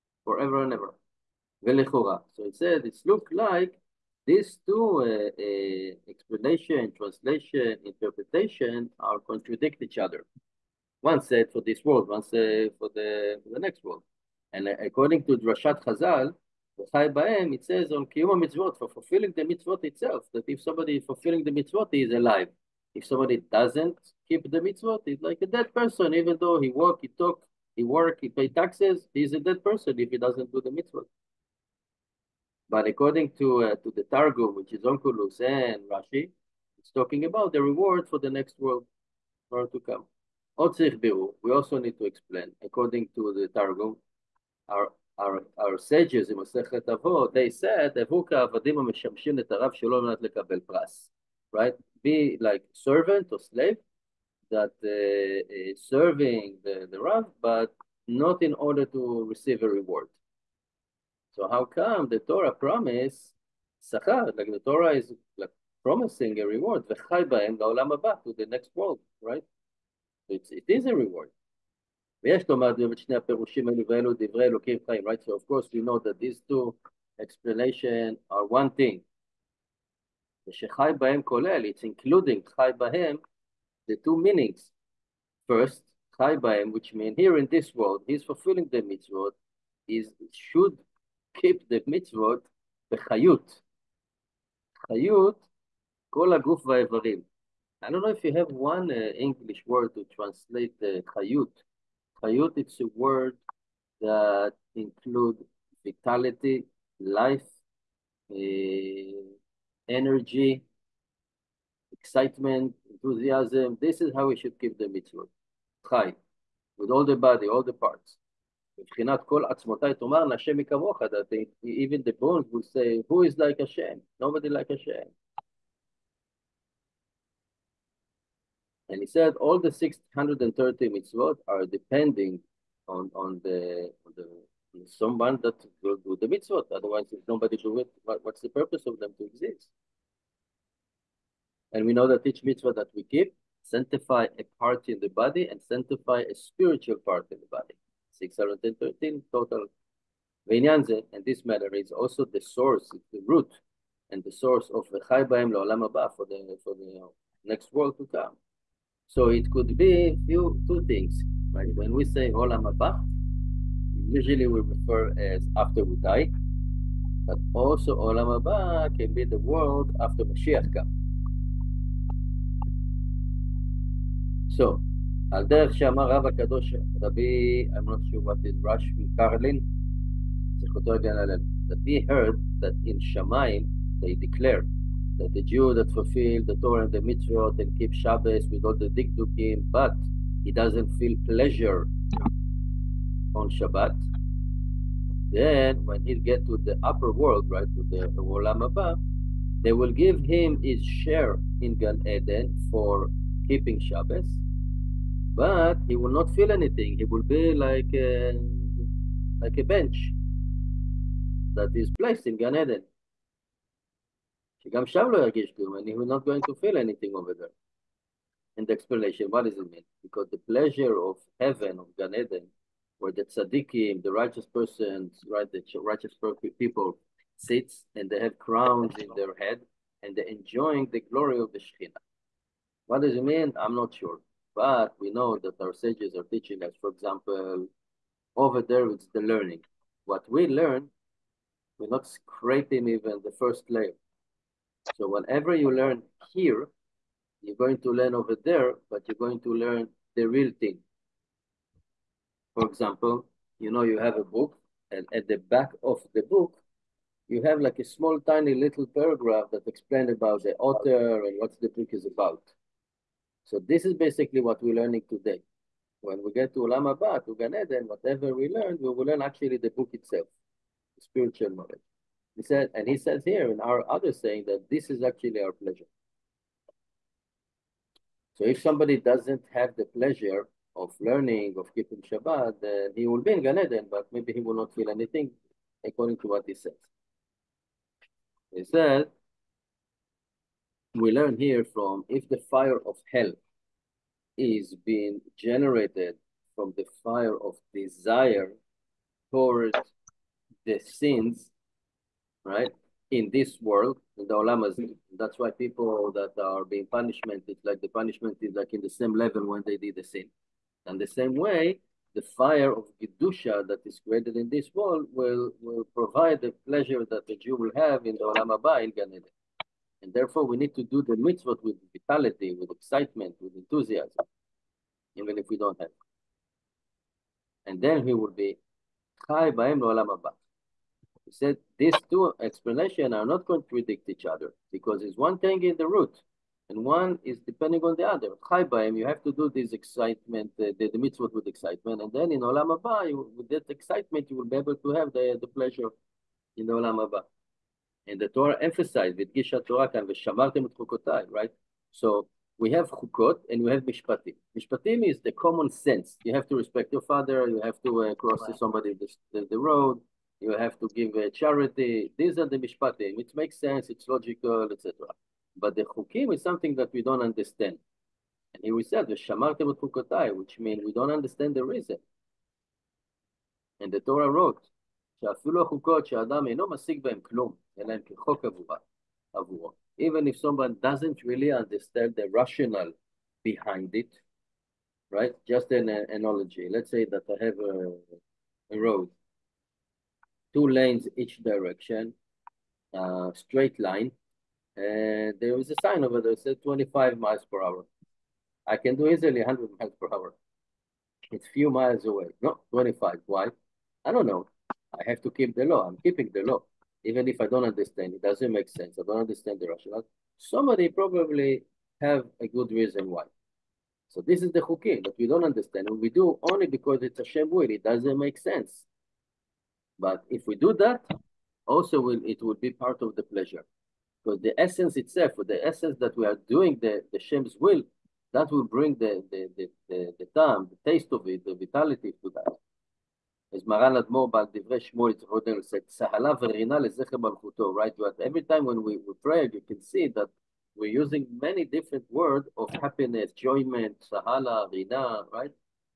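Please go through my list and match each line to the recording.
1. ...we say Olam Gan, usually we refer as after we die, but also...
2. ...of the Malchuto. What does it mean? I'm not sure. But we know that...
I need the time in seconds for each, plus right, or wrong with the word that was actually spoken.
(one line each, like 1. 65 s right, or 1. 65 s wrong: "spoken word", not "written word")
1. 161 s wrong: "Haba", not "Gan"
2. 231 s wrong: "Shekhinah", not "Malchuto".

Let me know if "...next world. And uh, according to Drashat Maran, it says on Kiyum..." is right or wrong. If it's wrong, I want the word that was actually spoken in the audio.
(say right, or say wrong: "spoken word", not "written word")
wrong: "Chazal", not "Maran".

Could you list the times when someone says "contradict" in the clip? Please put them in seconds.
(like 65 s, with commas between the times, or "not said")
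9 s, 333 s.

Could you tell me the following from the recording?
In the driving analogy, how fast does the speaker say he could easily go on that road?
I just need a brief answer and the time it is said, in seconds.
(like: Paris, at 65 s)
100 miles per hour, at 399 s.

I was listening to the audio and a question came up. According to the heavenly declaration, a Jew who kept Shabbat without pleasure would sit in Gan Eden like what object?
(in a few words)
a bench.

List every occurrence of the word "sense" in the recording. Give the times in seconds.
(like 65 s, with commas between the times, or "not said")
355 s, 363 s, 408 s, 418 s.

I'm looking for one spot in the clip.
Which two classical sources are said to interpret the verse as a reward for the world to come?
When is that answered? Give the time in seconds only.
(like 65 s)
34 s.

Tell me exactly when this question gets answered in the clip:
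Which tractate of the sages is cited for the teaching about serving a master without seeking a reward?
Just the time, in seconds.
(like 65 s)
46 s.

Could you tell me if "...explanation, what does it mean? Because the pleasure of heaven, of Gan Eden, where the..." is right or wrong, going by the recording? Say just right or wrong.
right.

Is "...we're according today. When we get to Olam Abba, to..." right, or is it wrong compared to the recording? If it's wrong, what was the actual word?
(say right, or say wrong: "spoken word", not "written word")
wrong: "learning", not "according".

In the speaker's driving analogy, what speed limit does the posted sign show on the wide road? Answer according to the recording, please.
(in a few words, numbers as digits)
25 miles per hour.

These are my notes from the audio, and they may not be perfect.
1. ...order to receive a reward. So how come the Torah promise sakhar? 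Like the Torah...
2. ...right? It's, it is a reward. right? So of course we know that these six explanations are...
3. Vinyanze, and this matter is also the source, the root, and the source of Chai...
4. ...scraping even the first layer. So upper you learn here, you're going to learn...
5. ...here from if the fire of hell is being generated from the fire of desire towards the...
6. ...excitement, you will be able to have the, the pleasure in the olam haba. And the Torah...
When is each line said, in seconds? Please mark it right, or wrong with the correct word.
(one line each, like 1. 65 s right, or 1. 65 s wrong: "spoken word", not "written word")
1. 58 s right
2. 69 s wrong: "two", not "six"
3. 150 s right
4. 242 s wrong: "whenever", not "upper"
5. 291 s right
6. 343 s right.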